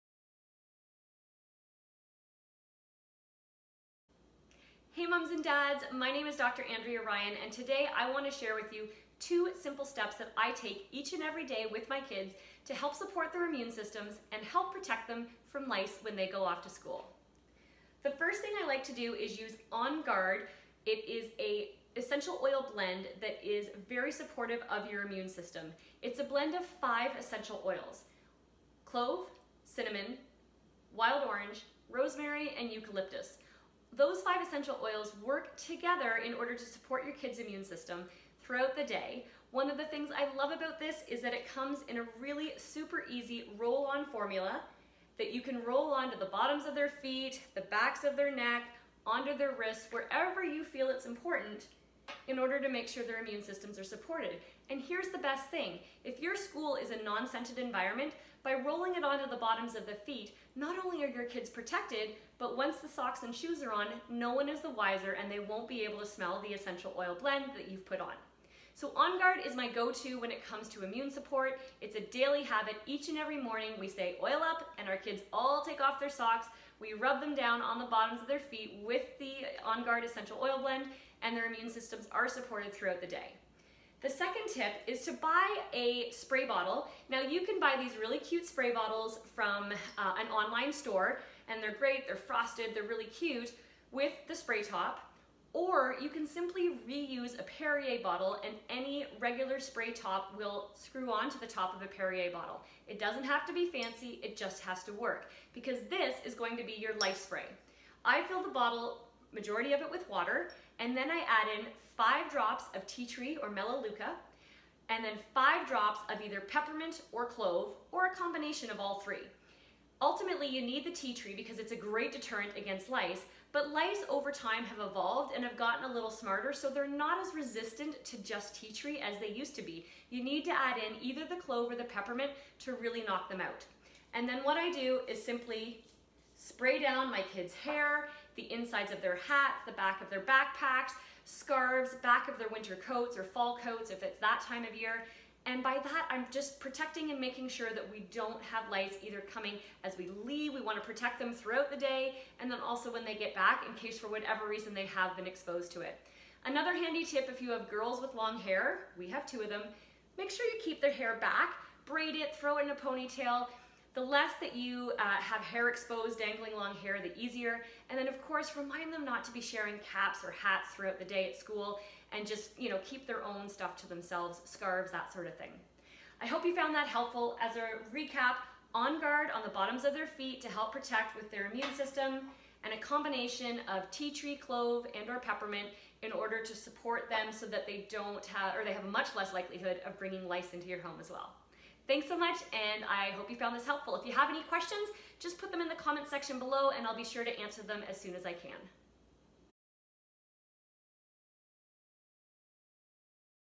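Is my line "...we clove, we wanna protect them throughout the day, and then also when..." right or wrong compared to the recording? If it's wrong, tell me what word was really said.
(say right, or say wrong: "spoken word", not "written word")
wrong: "leave", not "clove".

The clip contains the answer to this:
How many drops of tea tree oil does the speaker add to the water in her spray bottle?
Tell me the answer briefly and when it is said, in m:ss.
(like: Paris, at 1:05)
5, at 1:51.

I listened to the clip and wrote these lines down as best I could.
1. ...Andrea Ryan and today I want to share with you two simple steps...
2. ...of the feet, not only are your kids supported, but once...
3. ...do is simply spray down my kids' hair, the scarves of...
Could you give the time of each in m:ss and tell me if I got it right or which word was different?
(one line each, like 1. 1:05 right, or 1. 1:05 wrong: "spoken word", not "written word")
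1. 0:06 right
2. 0:59 wrong: "protected", not "supported"
3. 2:14 wrong: "insides", not "scarves".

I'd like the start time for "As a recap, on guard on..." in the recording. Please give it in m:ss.
2:57.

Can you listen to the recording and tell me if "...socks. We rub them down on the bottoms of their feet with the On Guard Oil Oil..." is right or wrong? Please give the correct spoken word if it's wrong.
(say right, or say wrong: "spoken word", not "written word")
wrong: "Essential", not "Oil".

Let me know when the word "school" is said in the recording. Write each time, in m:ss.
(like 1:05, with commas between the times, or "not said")
0:16, 0:56, 2:51.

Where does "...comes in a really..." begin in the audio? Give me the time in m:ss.
0:41.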